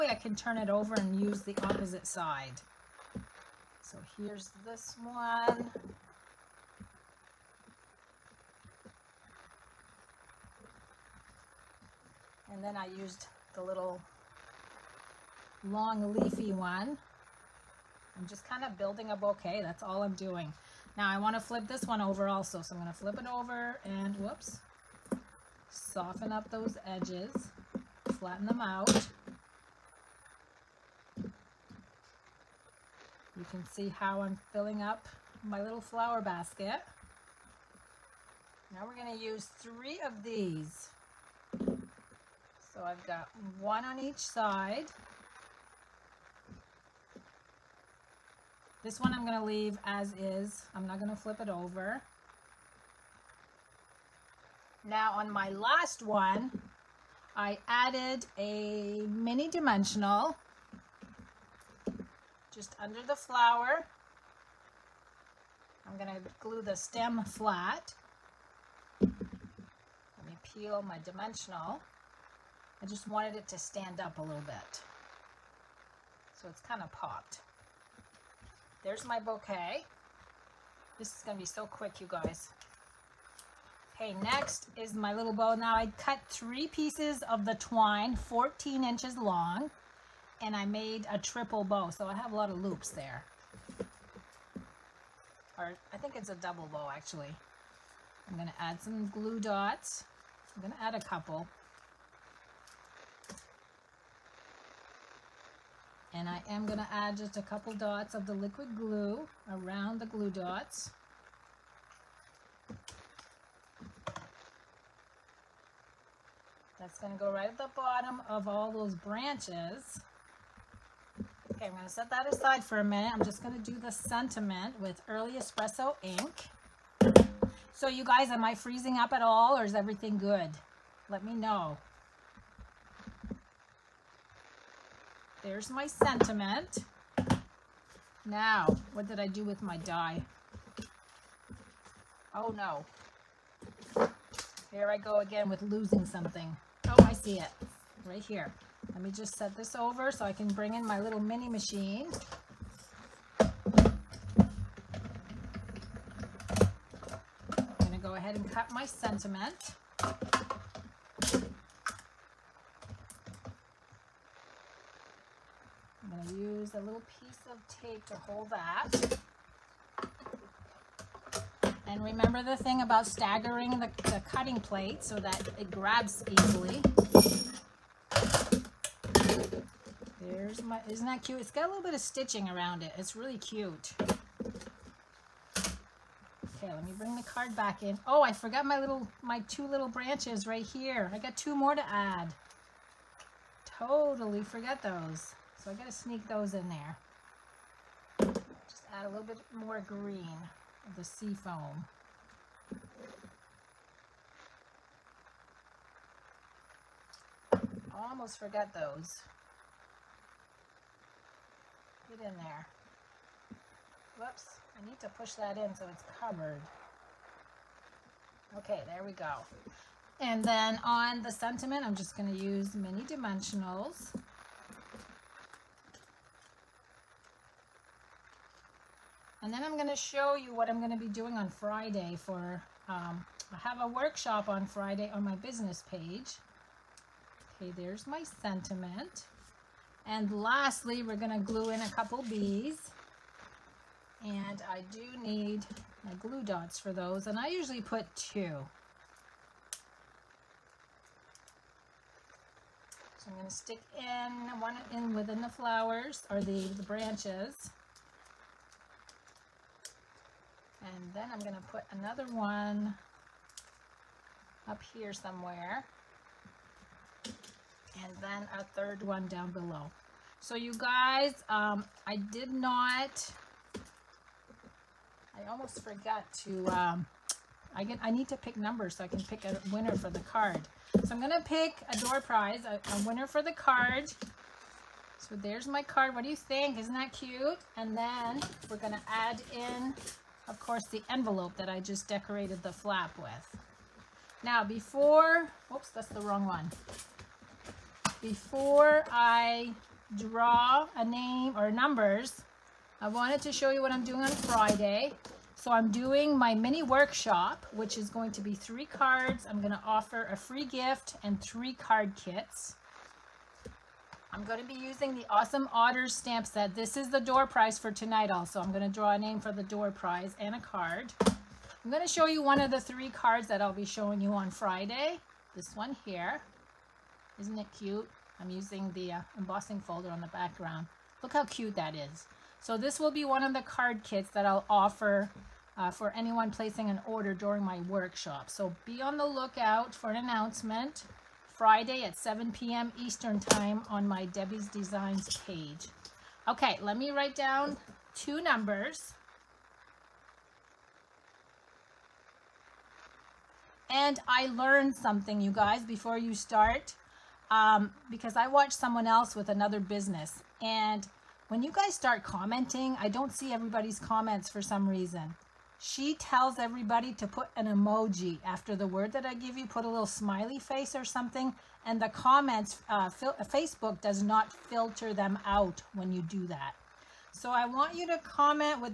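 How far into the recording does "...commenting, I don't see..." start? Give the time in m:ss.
6:02.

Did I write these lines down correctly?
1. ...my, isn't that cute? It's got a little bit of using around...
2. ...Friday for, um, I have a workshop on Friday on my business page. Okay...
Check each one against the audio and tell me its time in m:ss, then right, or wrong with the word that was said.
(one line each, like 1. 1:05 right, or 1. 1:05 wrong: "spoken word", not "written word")
1. 3:00 wrong: "stitching", not "using"
2. 3:51 right.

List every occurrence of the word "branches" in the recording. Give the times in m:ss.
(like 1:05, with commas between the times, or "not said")
1:58, 3:09, 4:16.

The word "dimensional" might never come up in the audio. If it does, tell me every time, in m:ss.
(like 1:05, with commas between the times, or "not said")
0:59, 1:11, 3:43.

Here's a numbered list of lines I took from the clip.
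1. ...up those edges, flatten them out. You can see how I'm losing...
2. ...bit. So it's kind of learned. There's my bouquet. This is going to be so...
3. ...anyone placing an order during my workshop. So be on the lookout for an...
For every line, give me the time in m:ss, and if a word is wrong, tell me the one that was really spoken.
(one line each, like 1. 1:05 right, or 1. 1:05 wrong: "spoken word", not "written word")
1. 0:26 wrong: "filling", not "losing"
2. 1:14 wrong: "popped", not "learned"
3. 5:36 right.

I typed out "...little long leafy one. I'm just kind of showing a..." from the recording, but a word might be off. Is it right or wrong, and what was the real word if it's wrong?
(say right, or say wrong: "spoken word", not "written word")
wrong: "building", not "showing".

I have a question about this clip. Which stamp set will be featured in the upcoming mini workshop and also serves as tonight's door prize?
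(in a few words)
Awesome Otters.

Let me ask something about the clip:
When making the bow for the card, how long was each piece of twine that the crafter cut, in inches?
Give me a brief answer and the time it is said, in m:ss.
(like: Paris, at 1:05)
14, at 1:28.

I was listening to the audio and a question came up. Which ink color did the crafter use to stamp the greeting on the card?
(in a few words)
Early Espresso.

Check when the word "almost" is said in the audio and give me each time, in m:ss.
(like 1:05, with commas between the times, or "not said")
3:27, 4:35.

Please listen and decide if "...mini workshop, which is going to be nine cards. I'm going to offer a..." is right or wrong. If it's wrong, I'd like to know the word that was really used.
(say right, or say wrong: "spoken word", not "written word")
wrong: "three", not "nine".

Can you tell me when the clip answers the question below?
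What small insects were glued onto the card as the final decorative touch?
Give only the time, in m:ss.
4:02.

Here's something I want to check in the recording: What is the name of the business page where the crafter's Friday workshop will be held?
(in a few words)
Debbie's Designs.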